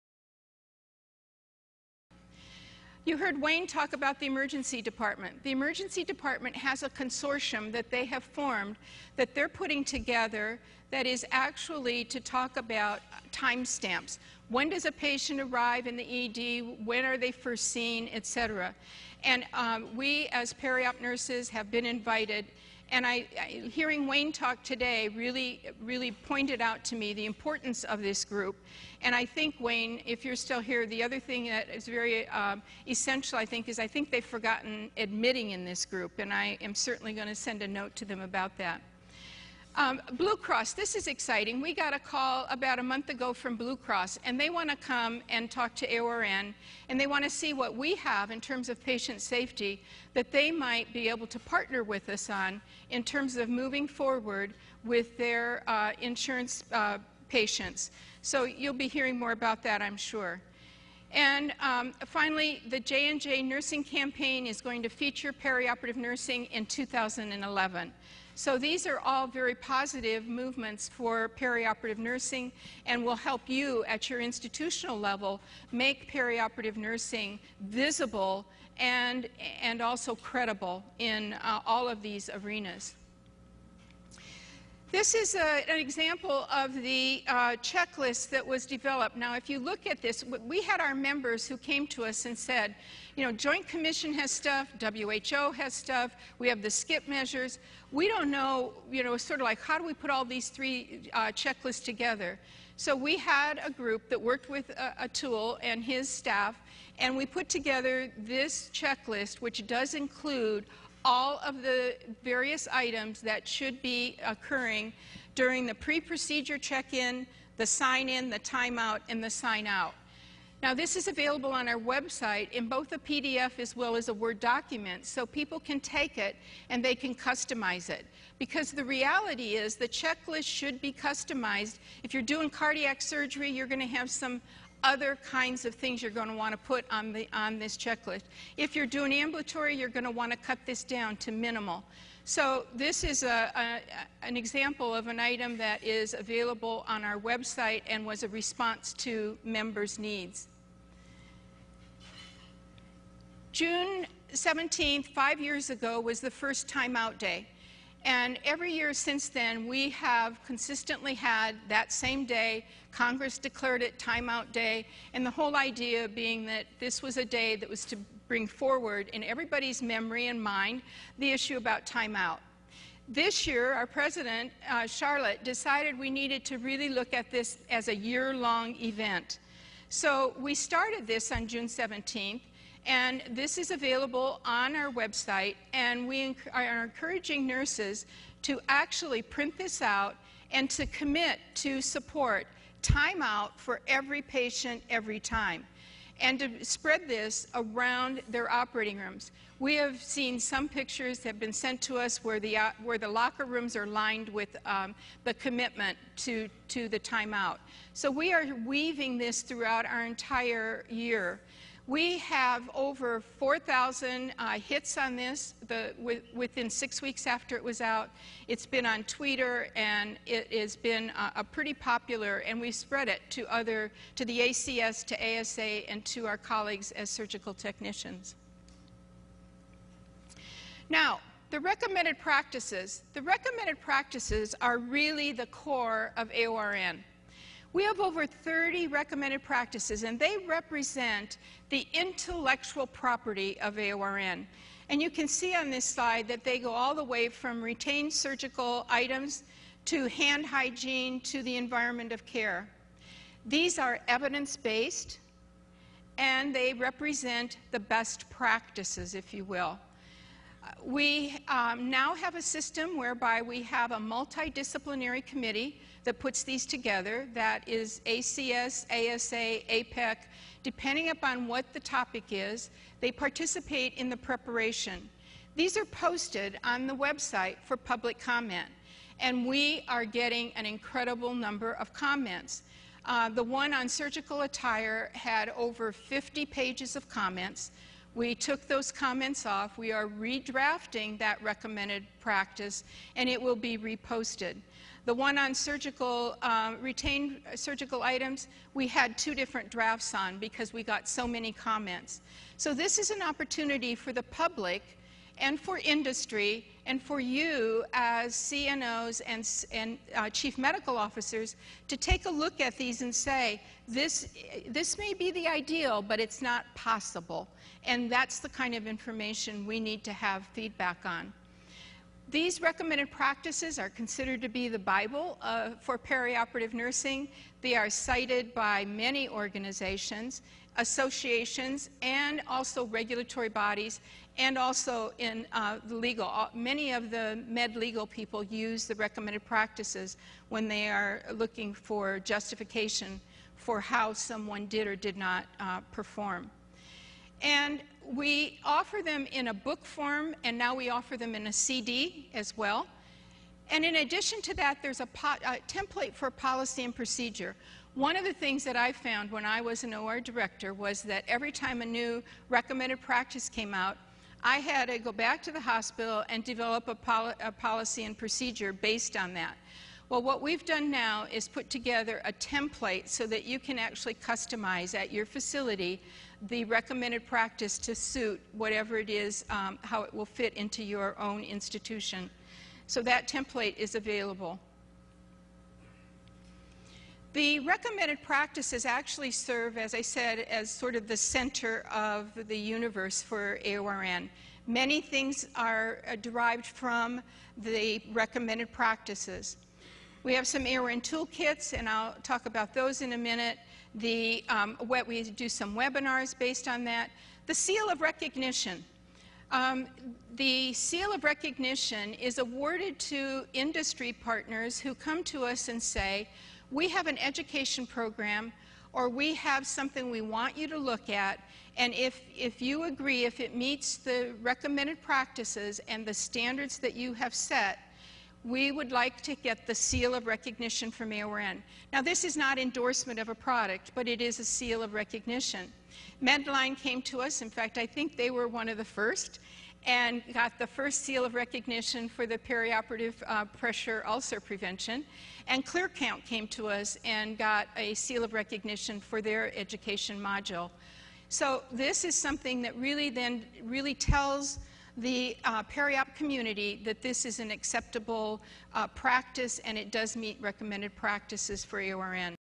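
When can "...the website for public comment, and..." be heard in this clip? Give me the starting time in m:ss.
4:36.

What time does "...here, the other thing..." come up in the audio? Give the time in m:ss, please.
0:30.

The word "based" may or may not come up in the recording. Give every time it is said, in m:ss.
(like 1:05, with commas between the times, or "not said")
4:14, 6:08, 6:46.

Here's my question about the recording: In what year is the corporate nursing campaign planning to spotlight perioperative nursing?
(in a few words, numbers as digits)
2011.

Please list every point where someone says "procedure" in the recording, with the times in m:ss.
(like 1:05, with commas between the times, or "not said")
1:55, 5:56, 6:08.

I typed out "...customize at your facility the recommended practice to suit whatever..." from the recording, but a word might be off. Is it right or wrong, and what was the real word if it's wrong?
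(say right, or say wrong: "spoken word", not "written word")
right.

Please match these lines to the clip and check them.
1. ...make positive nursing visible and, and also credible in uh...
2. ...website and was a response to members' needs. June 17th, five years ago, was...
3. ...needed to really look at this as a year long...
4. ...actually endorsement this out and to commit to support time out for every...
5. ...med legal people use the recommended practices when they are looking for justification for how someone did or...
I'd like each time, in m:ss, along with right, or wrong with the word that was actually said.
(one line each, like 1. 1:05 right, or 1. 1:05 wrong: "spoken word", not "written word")
1. 1:15 wrong: "perioperative", not "positive"
2. 2:27 right
3. 2:56 right
4. 3:08 wrong: "print", not "endorsement"
5. 5:37 right.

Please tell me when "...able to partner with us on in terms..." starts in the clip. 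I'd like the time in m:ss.
0:51.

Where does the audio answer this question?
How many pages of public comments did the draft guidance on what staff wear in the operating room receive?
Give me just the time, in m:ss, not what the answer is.
4:45.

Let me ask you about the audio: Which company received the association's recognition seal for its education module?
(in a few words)
ClearCount.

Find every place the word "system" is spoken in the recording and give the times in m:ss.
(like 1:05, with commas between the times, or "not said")
4:22.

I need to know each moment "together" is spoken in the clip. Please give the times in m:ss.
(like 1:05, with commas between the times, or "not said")
0:09, 1:41, 1:47, 4:26, 6:11.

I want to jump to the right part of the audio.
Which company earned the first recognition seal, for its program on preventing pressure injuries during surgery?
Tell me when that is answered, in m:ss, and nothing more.
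7:16.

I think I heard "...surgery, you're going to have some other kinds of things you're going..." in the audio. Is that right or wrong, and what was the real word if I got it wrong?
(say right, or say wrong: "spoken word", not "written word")
right.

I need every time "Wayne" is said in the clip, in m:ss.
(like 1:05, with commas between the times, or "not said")
0:03, 0:24, 0:29.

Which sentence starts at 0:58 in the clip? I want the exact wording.
So you'll be hearing more about that, I'm sure.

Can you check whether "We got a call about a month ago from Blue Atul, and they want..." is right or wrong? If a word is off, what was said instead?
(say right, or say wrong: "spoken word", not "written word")
wrong: "Cross", not "Atul".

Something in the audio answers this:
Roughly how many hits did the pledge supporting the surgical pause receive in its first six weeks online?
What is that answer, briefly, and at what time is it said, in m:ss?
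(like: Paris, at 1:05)
4,000, at 3:33.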